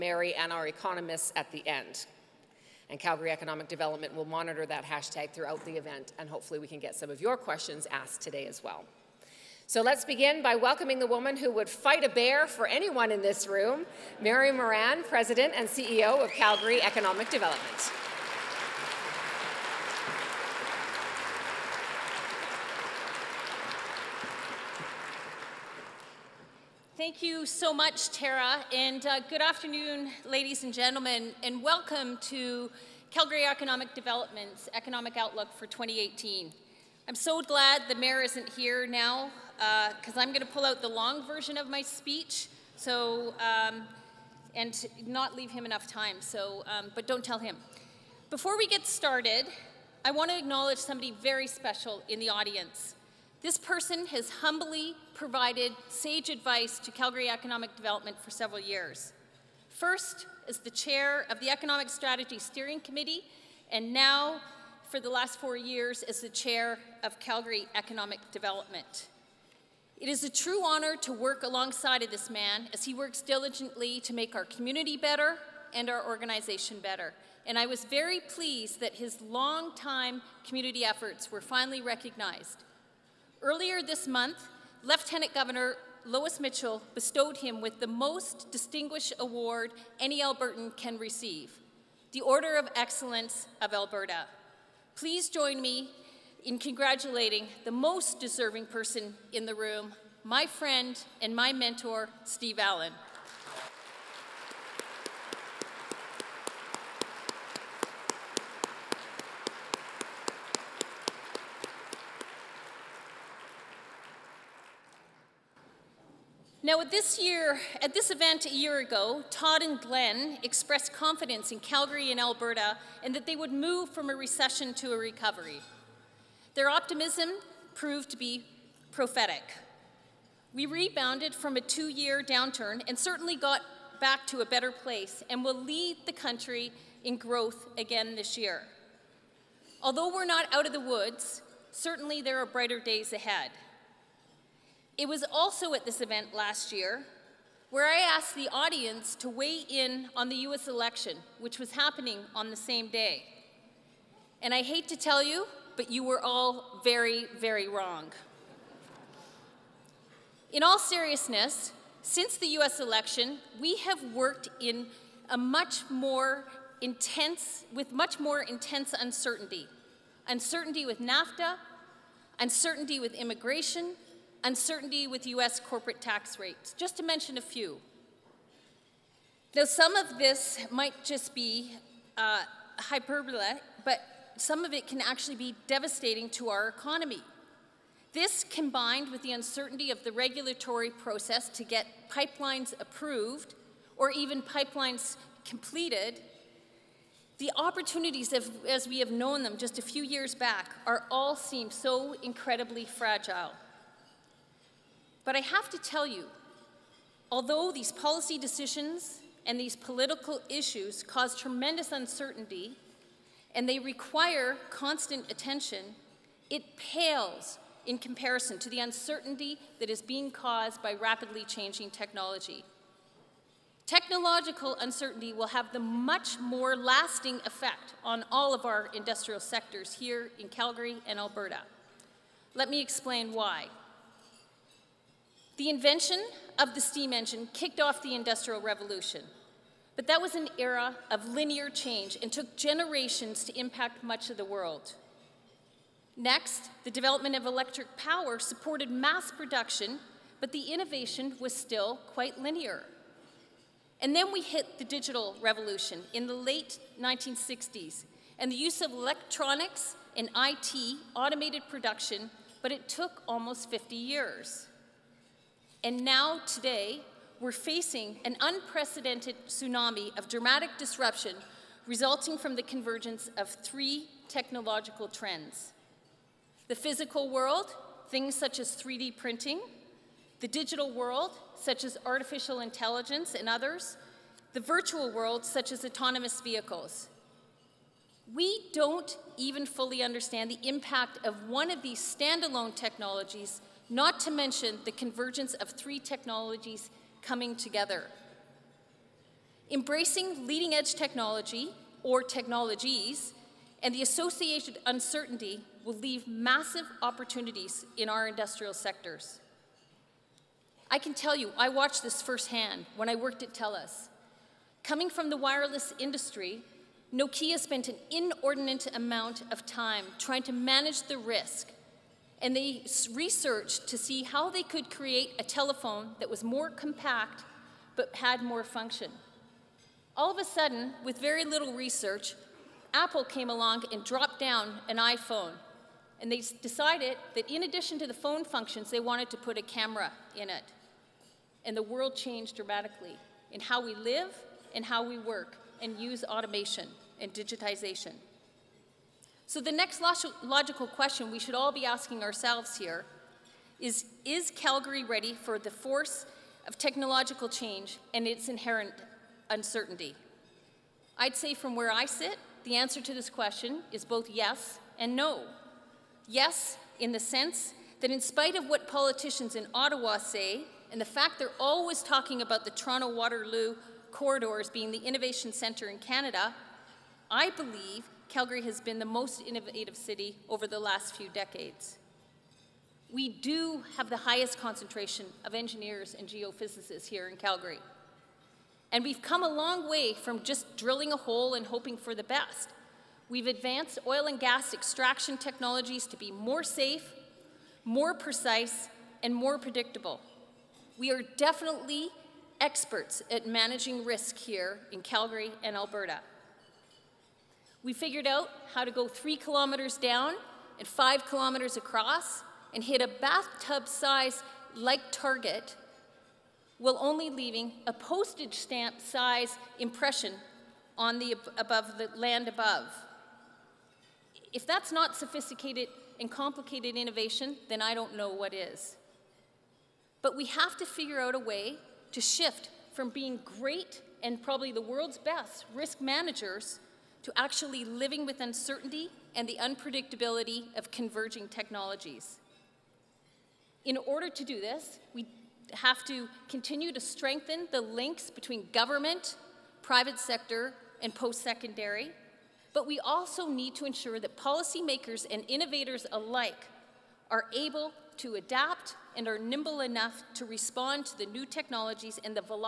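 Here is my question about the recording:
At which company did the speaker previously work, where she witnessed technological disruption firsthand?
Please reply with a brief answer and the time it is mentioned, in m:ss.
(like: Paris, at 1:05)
TELUS, at 5:13.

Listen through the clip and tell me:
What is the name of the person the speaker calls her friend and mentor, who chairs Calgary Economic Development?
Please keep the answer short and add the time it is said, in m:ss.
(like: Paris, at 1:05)
Steve Allen, at 1:42.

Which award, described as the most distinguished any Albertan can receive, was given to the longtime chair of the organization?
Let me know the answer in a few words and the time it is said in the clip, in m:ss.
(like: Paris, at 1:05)
Order of Excellence of Alberta, at 1:32.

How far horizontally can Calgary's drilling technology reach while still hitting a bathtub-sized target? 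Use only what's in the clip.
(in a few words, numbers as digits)
5 kilometers.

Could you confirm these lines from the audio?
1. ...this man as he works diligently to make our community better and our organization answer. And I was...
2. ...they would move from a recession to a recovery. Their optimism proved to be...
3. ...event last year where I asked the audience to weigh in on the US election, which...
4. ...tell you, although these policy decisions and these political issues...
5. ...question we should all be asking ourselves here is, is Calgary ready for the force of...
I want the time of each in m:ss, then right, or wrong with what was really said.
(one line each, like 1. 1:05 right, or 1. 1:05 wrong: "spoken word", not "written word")
1. 1:12 wrong: "better", not "answer"
2. 2:03 right
3. 2:25 right
4. 3:25 right
5. 5:50 right.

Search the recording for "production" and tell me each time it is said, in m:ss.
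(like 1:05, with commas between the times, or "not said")
4:09, 4:21.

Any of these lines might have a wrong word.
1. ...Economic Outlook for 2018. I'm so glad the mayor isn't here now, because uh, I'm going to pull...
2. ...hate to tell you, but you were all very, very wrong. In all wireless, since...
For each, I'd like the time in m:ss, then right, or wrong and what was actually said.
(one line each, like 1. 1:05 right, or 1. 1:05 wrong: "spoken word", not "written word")
1. 0:34 right
2. 2:34 wrong: "seriousness", not "wireless".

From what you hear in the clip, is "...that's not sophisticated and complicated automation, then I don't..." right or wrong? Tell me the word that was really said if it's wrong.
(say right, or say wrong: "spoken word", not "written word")
wrong: "innovation", not "automation".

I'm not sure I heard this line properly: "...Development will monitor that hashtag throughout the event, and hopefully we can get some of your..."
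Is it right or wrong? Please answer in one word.
right.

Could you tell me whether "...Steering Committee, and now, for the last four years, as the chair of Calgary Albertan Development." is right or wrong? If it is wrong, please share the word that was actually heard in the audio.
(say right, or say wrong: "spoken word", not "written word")
wrong: "Economic", not "Albertan".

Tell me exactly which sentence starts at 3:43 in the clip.
Technological uncertainty will have the much more lasting effect on all of our industrial sectors here in Calgary and Alberta.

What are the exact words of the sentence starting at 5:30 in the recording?
All of a sudden, with very little research, Apple came along and dropped down an iPhone.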